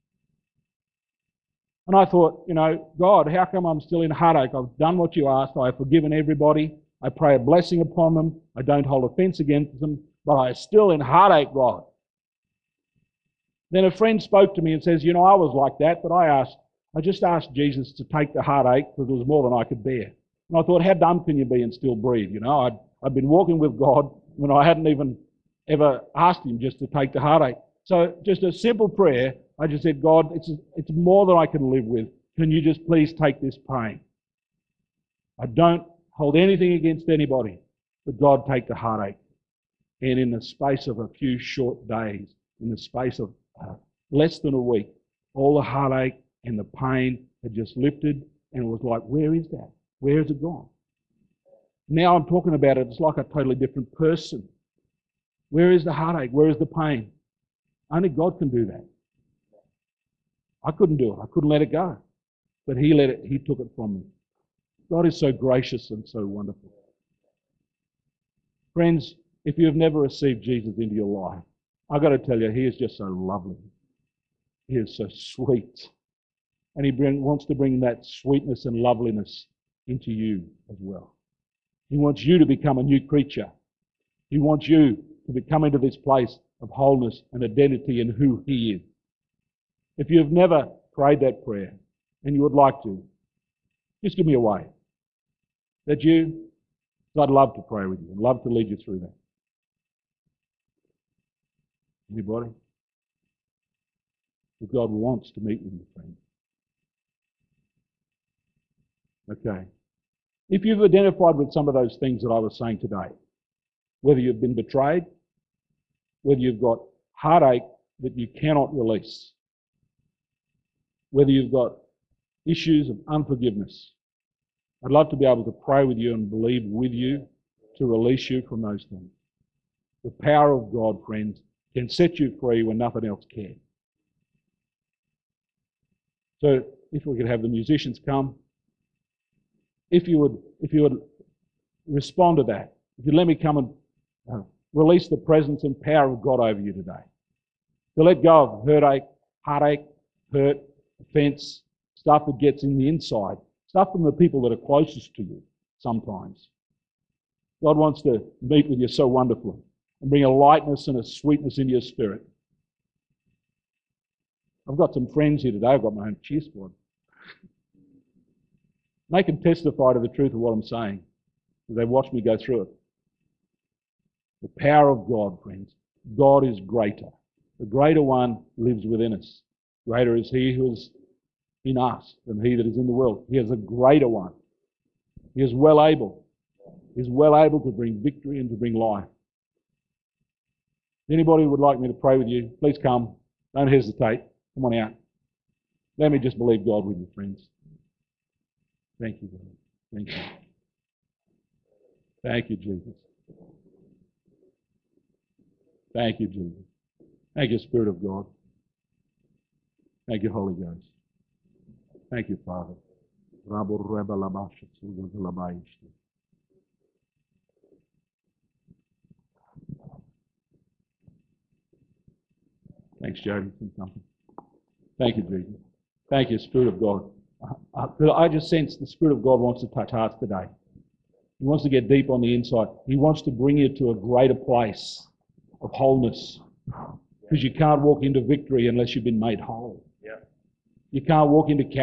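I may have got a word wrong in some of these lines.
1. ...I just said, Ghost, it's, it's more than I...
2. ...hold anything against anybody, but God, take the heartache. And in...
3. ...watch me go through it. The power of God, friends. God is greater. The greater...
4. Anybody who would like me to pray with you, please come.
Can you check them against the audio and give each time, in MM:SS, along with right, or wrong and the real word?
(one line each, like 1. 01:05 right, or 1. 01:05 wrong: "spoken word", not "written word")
1. 00:29 wrong: "God", not "Ghost"
2. 00:36 right
3. 02:51 right
4. 03:11 right.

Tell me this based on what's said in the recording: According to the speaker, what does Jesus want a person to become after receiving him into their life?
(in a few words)
A new creature.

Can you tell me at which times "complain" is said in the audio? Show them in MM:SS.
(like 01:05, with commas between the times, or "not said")
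not said.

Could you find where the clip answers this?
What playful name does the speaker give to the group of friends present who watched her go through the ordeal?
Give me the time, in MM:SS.
02:46.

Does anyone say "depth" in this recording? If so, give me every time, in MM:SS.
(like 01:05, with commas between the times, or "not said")
not said.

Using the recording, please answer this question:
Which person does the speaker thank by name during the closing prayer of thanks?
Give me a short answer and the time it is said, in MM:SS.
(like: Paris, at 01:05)
Jody, at 03:43.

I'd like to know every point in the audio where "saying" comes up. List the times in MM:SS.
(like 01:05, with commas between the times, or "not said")
01:52, 02:50.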